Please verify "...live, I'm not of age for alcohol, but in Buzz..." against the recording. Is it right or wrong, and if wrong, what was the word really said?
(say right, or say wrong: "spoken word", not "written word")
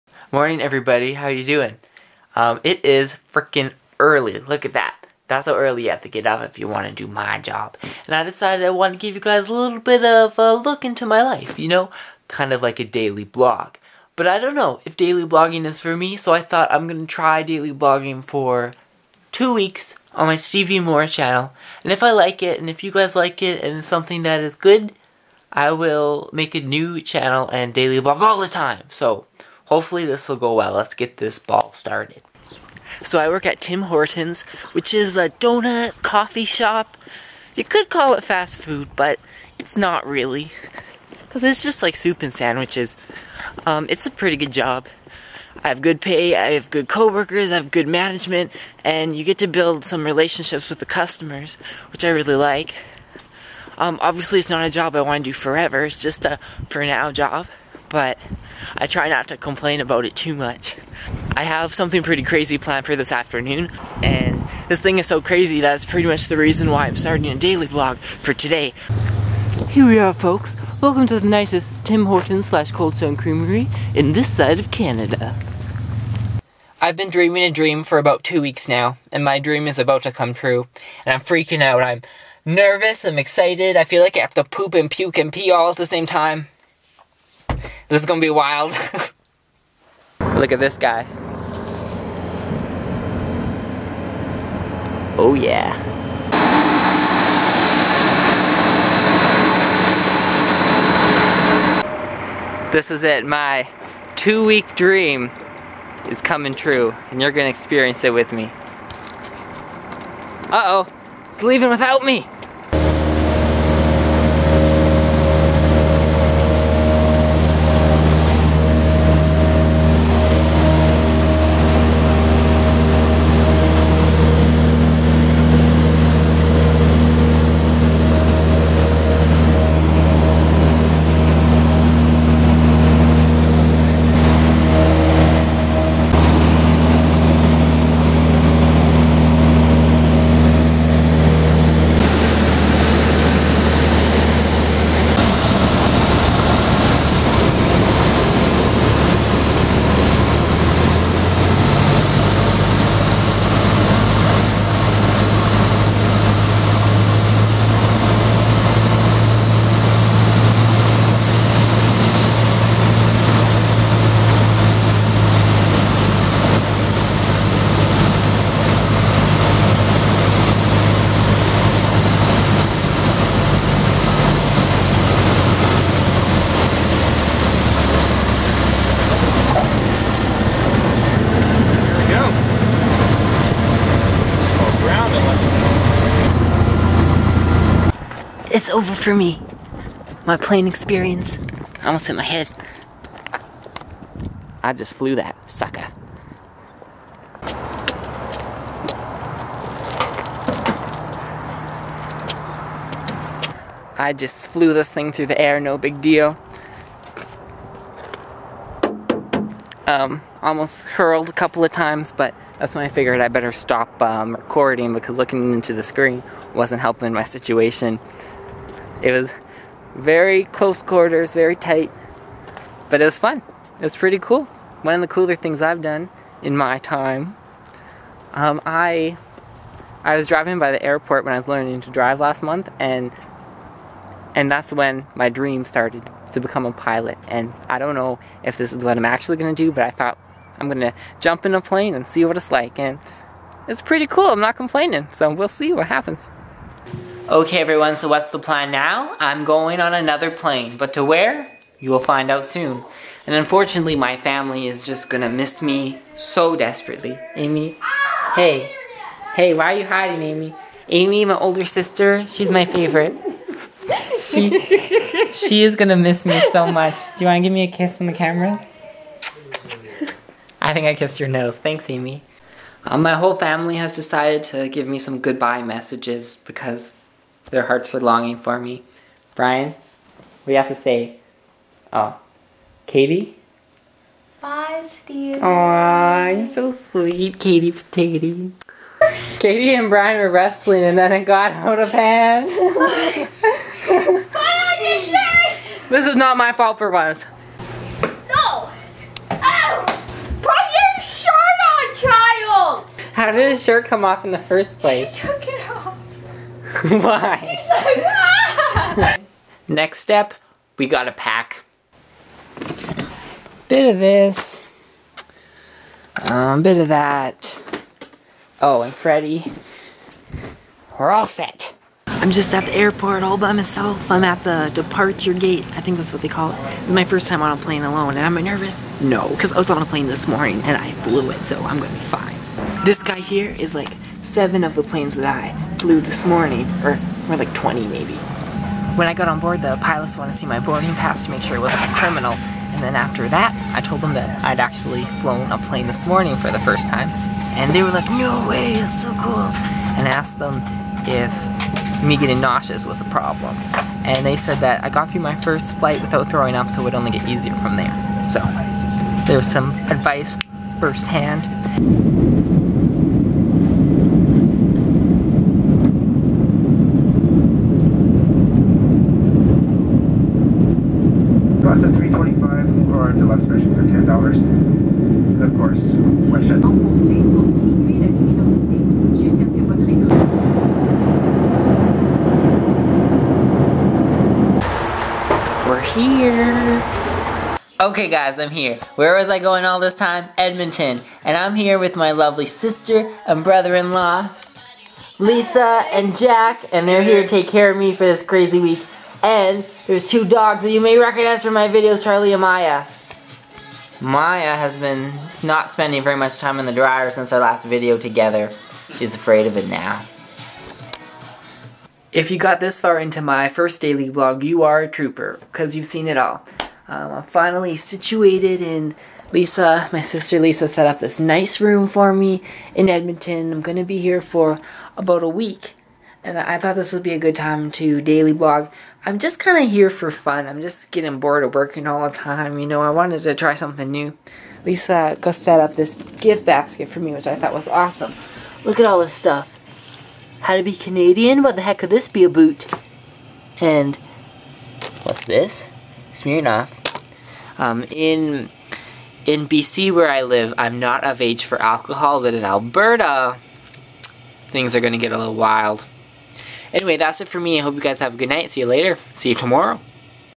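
wrong: "Alberta", not "Buzz".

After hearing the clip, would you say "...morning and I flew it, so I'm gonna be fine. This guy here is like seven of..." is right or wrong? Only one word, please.
right.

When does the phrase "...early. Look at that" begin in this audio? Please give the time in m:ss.
0:03.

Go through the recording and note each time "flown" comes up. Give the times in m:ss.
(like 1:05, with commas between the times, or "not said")
5:45.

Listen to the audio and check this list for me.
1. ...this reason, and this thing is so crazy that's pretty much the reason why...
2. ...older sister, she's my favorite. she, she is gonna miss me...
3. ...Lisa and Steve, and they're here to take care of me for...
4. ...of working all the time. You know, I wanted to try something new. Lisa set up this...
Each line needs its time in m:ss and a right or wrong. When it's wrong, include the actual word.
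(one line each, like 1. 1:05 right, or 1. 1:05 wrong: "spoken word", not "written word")
1. 1:02 wrong: "afternoon", not "reason"
2. 4:21 right
3. 6:35 wrong: "Jack", not "Steve"
4. 7:11 right.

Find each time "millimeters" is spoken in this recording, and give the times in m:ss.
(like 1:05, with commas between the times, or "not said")
not said.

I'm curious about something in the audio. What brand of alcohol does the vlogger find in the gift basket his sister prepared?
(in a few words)
Smirnoff.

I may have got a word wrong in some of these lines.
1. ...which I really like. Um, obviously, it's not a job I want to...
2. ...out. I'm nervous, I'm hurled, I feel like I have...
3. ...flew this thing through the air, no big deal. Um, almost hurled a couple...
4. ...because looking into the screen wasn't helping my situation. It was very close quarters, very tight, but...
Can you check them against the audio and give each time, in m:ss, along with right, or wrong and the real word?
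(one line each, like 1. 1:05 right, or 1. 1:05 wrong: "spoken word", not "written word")
1. 0:51 right
2. 1:21 wrong: "excited", not "hurled"
3. 3:24 right
4. 3:34 right.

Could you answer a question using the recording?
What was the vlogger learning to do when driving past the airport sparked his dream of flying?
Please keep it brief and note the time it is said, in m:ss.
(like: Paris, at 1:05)
to drive, at 3:51.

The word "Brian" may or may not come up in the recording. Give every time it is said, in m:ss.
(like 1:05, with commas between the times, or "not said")
4:39, 4:49.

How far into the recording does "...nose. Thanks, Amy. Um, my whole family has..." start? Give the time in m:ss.
4:31.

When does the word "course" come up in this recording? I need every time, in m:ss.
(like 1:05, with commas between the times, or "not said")
6:15.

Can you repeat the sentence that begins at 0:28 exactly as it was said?
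So, Hopefully this will go well.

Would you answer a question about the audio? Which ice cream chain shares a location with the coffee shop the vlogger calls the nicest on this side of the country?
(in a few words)
Cold Stone Creamery.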